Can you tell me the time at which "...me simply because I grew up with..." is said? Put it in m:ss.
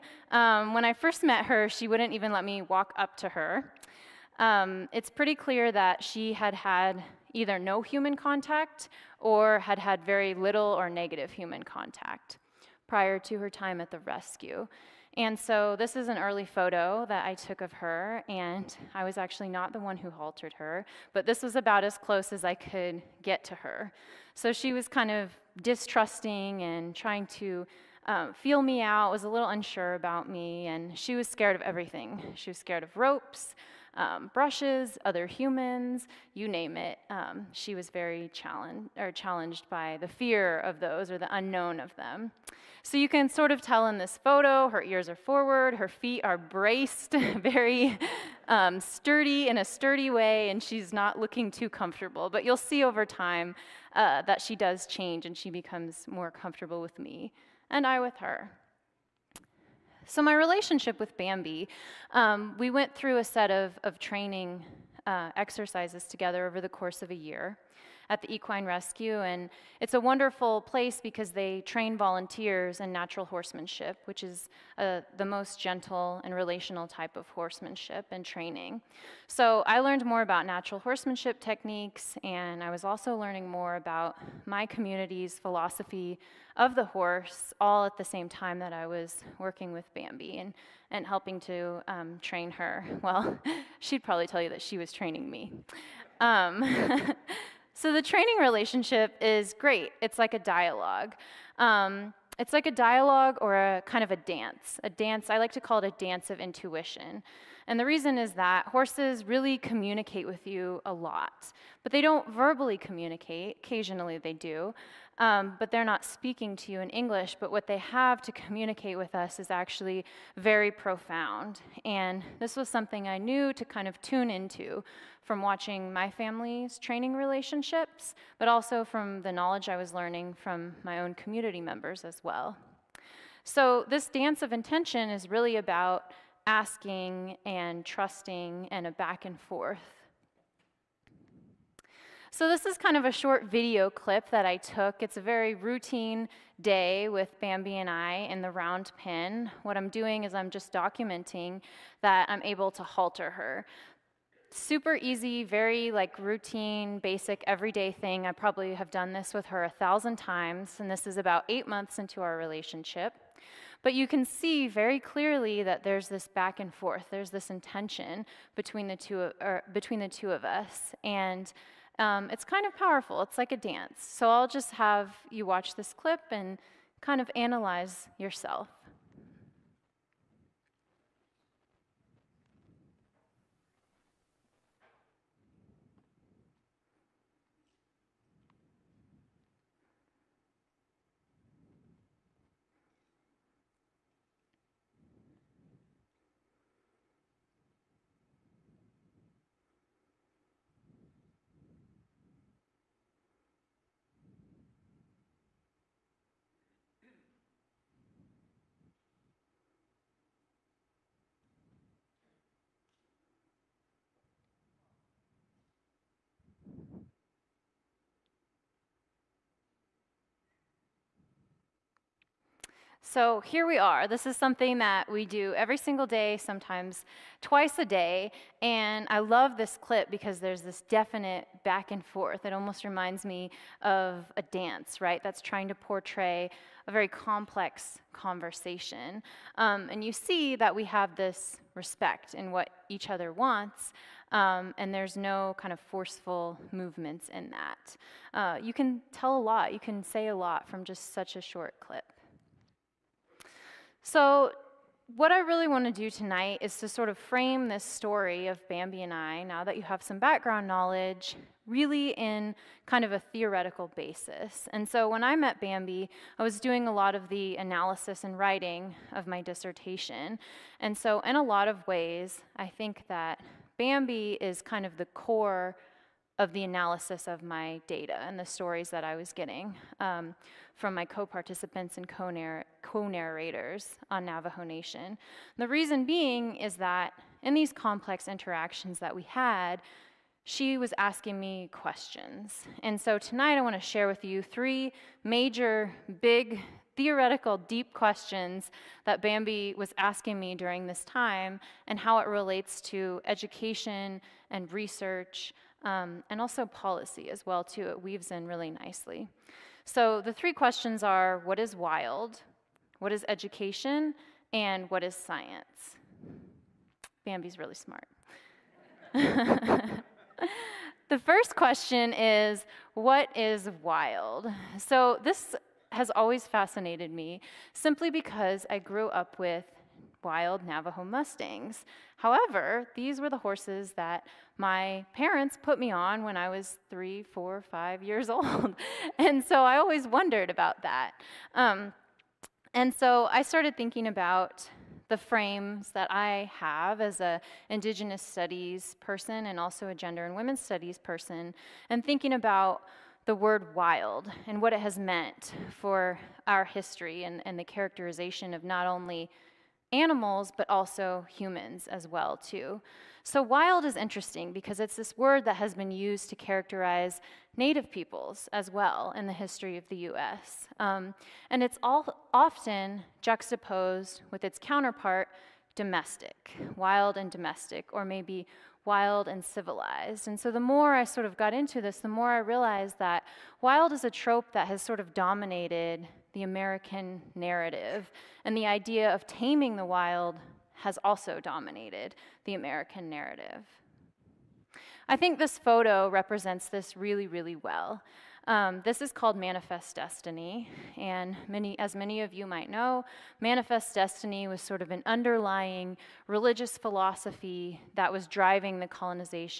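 5:27.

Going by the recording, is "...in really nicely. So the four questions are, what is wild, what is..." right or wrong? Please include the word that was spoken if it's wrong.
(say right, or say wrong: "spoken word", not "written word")
wrong: "three", not "four".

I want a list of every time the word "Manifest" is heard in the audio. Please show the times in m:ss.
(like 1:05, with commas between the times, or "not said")
6:39, 6:43.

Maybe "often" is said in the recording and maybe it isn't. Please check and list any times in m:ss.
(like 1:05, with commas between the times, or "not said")
6:12.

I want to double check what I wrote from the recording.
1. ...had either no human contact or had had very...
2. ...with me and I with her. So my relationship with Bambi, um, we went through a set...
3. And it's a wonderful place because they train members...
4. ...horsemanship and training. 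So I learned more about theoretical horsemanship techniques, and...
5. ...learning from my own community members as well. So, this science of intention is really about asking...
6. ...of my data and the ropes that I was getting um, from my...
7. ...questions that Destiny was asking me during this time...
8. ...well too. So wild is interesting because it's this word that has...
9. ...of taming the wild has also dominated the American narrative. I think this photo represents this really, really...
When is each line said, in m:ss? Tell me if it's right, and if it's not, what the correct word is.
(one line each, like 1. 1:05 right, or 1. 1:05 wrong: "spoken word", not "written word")
1. 0:06 right
2. 0:56 right
3. 1:09 wrong: "volunteers", not "members"
4. 1:17 wrong: "natural", not "theoretical"
5. 2:09 wrong: "dance", not "science"
6. 4:37 wrong: "stories", not "ropes"
7. 4:57 wrong: "Bambi", not "Destiny"
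8. 6:02 right
9. 6:29 right.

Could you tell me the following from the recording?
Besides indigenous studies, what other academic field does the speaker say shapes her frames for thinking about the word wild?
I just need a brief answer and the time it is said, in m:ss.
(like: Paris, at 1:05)
Gender and women's studies, at 5:49.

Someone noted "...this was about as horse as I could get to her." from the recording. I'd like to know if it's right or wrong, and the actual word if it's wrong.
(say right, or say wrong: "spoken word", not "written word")
wrong: "close", not "horse".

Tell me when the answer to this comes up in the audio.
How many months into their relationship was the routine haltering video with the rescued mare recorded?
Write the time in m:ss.
2:41.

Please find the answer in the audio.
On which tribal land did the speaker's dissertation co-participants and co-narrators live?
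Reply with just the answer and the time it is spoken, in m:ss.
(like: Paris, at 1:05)
Navajo Nation, at 4:44.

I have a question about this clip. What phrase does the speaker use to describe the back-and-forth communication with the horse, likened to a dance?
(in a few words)
Dance of intuition.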